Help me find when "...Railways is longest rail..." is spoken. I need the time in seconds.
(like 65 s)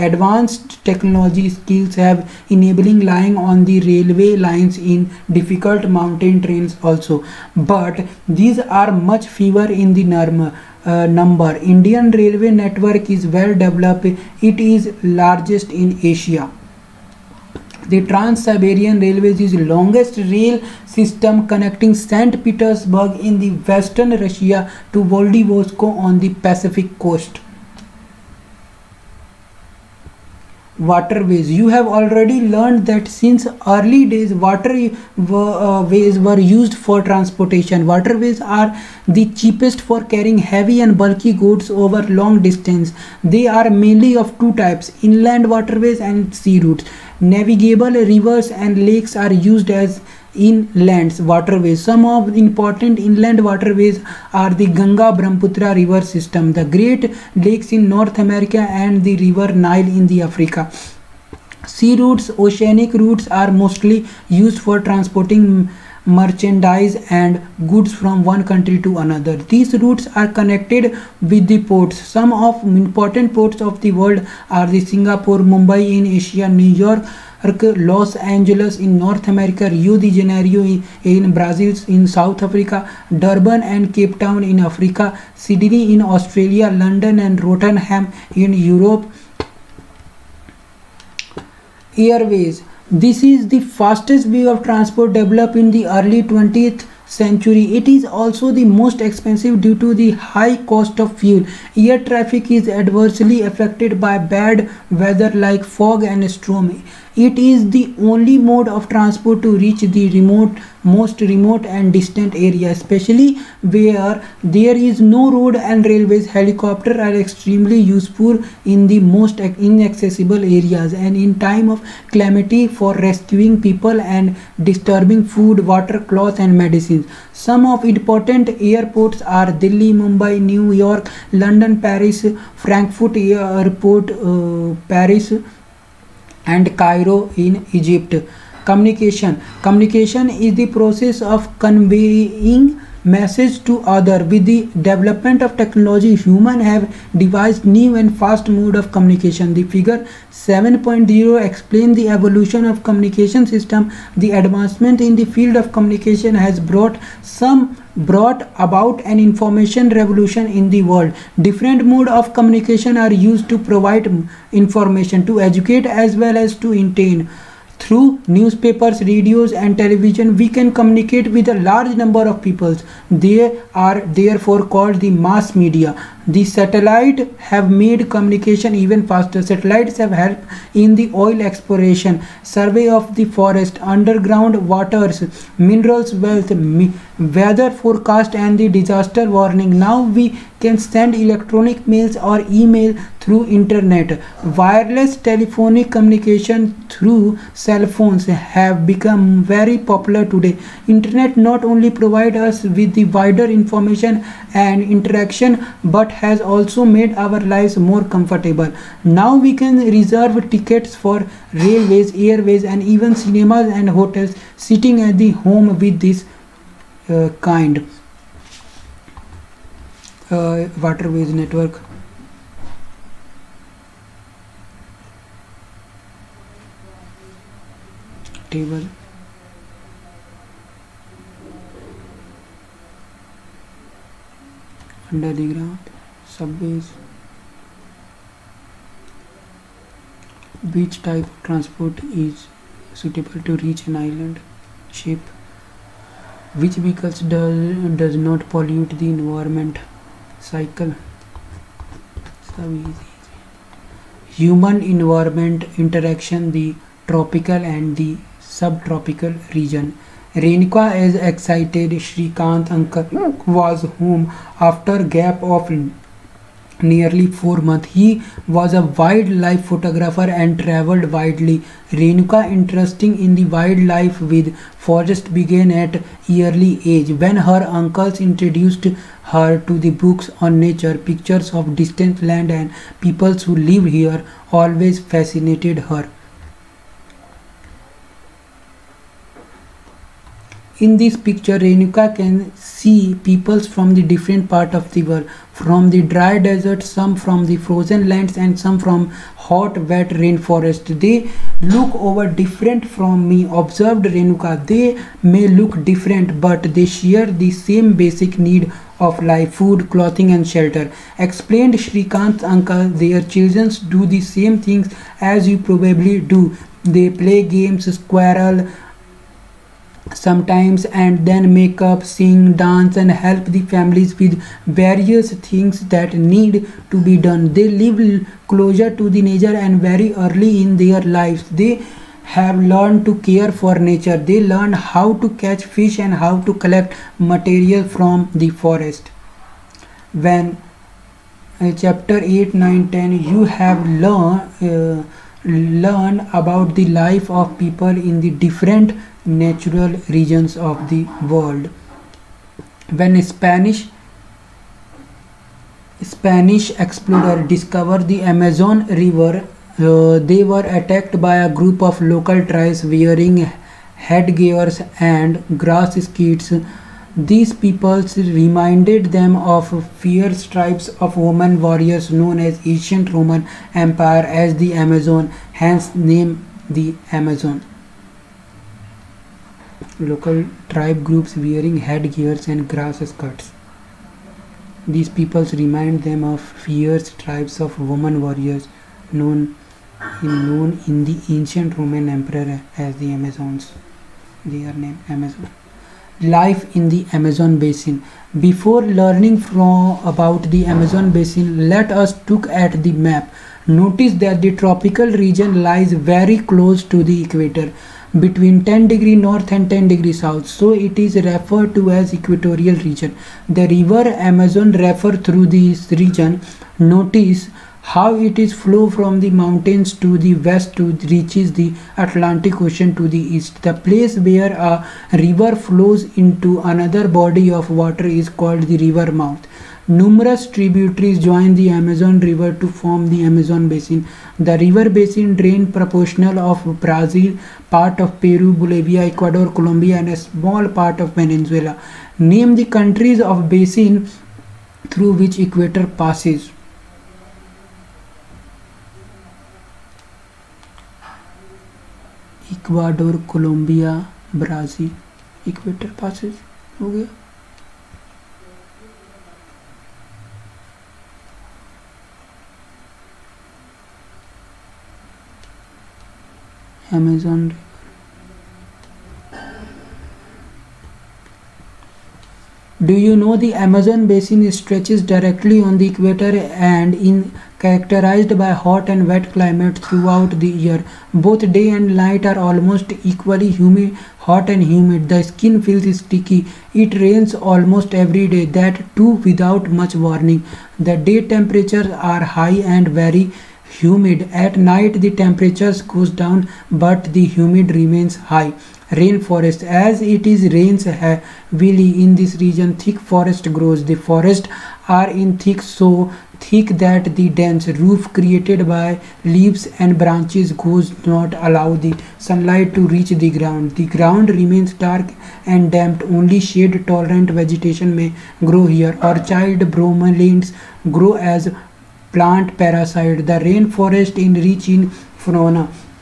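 19 s.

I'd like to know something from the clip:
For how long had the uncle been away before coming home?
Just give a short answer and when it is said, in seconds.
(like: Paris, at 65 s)
nearly 4 months, at 266 s.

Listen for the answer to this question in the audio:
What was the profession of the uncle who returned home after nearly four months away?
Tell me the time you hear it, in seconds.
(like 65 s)
268 s.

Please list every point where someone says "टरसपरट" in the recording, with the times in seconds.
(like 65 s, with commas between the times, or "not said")
241 s.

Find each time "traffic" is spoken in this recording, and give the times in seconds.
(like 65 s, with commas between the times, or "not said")
102 s.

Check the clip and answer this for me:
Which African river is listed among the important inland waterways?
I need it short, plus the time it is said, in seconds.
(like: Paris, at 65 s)
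Nile, at 59 s.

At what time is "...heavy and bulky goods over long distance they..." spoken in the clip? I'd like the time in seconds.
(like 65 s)
40 s.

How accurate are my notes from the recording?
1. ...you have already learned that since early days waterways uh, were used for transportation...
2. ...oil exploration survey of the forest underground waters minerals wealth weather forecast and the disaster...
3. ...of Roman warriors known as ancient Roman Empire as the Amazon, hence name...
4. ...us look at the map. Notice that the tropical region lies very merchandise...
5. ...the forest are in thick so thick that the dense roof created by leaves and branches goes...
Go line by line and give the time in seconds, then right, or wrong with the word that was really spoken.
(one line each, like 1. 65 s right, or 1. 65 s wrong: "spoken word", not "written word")
1. 31 s right
2. 181 s right
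3. 371 s right
4. 401 s wrong: "close", not "merchandise"
5. 503 s right.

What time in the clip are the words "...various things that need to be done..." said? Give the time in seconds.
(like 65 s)
324 s.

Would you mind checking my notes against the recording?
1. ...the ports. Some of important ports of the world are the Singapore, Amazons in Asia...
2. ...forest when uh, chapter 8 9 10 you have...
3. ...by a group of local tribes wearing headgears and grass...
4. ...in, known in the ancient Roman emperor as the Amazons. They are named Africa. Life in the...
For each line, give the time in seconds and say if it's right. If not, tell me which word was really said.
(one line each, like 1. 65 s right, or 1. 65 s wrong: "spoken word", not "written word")
1. 71 s wrong: "Mumbai", not "Amazons"
2. 338 s right
3. 361 s right
4. 390 s wrong: "Amazon", not "Africa".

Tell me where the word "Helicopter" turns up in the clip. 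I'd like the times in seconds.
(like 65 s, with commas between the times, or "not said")
116 s.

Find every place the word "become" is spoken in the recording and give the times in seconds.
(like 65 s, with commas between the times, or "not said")
198 s.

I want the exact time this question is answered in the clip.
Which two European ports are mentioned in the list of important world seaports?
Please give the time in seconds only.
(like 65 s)
86 s.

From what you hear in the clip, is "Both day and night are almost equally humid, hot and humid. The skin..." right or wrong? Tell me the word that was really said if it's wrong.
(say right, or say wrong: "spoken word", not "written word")
right.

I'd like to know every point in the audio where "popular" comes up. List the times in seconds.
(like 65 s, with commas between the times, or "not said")
199 s.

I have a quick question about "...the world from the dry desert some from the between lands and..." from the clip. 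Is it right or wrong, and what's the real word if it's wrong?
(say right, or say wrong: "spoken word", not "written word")
wrong: "frozen", not "between".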